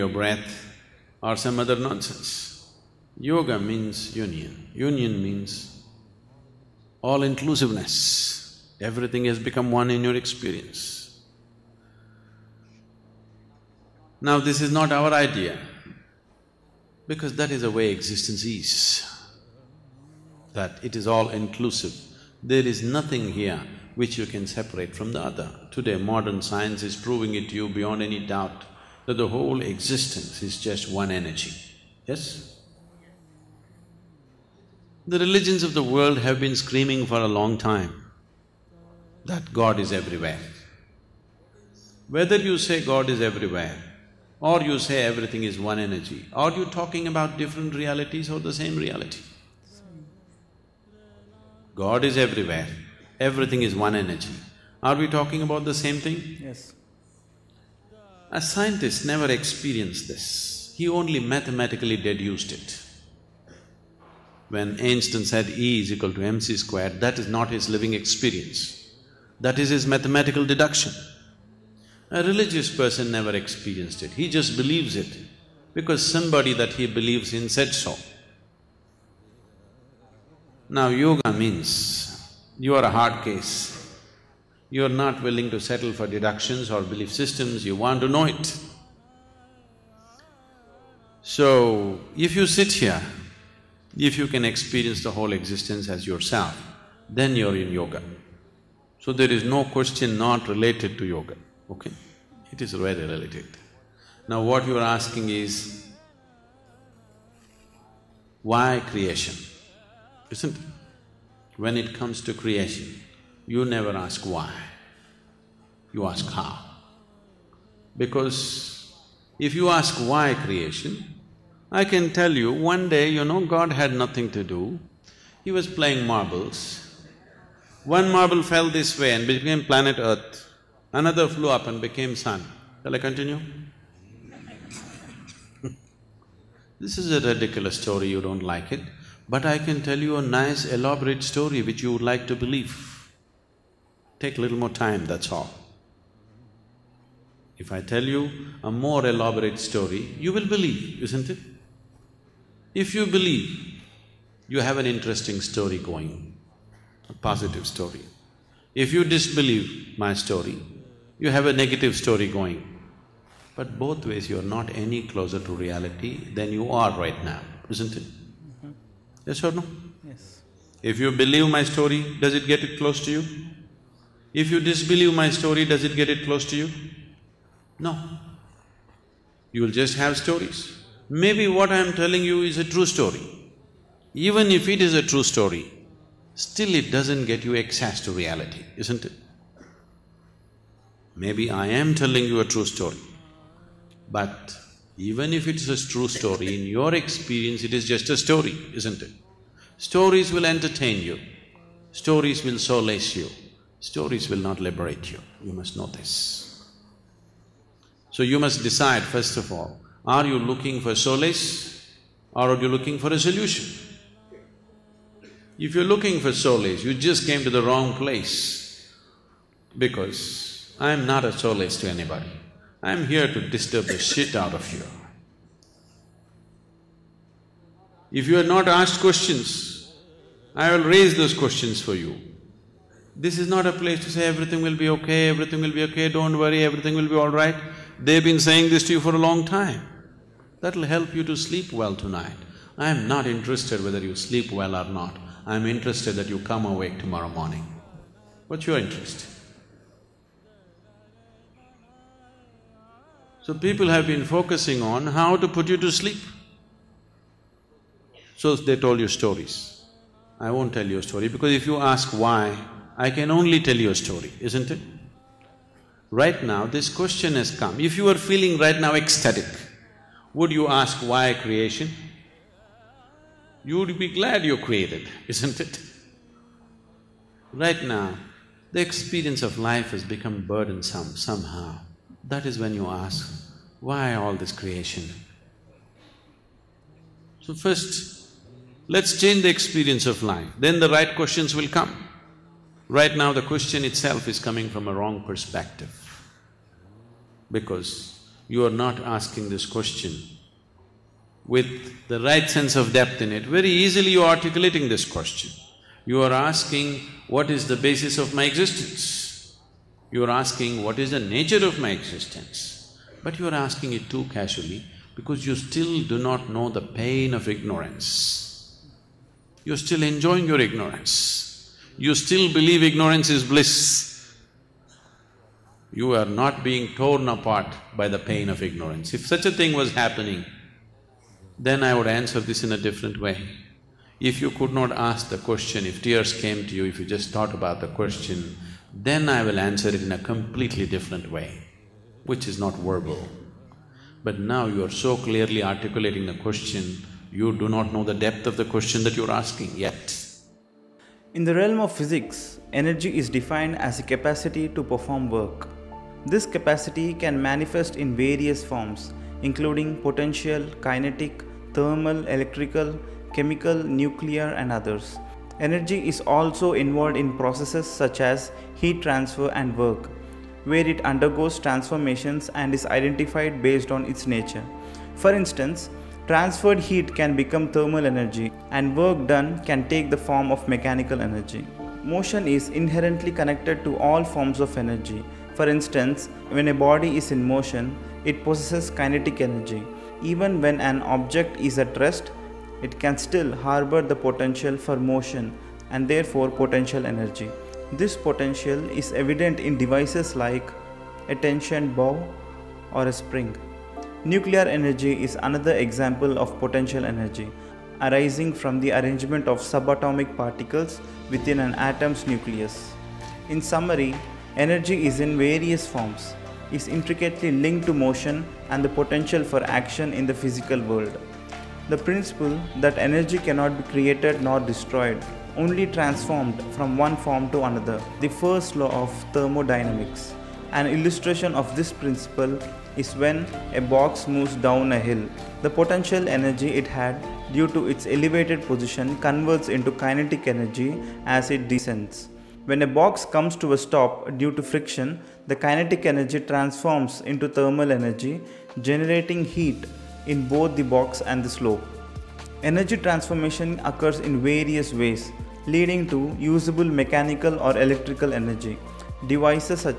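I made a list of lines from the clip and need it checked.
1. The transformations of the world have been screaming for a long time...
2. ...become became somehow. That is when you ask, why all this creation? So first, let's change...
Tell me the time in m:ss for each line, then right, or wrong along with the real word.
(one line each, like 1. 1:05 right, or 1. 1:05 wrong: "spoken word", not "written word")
1. 0:35 wrong: "religions", not "transformations"
2. 4:40 wrong: "burdensome", not "became".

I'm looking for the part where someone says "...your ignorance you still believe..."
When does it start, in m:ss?
5:20.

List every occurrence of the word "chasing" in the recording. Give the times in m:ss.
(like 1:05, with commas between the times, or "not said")
not said.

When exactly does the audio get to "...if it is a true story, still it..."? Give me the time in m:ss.
3:04.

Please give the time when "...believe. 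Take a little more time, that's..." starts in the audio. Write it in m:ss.
2:22.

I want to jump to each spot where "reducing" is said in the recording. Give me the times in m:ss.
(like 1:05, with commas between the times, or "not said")
not said.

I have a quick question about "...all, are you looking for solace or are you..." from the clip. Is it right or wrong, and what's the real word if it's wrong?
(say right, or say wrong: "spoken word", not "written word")
right.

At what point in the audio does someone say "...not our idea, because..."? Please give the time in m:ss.
0:14.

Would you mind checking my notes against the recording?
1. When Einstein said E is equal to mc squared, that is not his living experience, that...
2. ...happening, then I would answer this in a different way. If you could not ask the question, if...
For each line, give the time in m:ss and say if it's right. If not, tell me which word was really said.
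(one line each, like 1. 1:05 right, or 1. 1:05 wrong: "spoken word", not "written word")
1. 1:04 right
2. 5:29 right.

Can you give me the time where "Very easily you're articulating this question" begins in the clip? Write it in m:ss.
5:03.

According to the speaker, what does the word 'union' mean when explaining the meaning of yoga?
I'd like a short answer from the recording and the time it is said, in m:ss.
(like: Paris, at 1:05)
All-inclusiveness, at 0:07.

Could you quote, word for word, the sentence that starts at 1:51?
When it comes to creation, you never ask why, you ask how.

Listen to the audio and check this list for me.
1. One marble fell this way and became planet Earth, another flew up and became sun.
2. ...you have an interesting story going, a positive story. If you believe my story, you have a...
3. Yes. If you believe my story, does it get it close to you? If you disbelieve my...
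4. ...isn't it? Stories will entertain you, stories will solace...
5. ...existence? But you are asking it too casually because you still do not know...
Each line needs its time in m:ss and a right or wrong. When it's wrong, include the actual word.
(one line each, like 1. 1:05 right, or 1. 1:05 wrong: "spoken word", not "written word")
1. 2:07 right
2. 2:34 wrong: "disbelieve", not "believe"
3. 2:50 right
4. 3:18 right
5. 5:11 right.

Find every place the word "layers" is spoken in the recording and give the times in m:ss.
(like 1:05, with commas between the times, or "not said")
not said.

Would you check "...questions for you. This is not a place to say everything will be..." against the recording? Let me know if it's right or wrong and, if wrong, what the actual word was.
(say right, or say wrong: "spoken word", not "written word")
right.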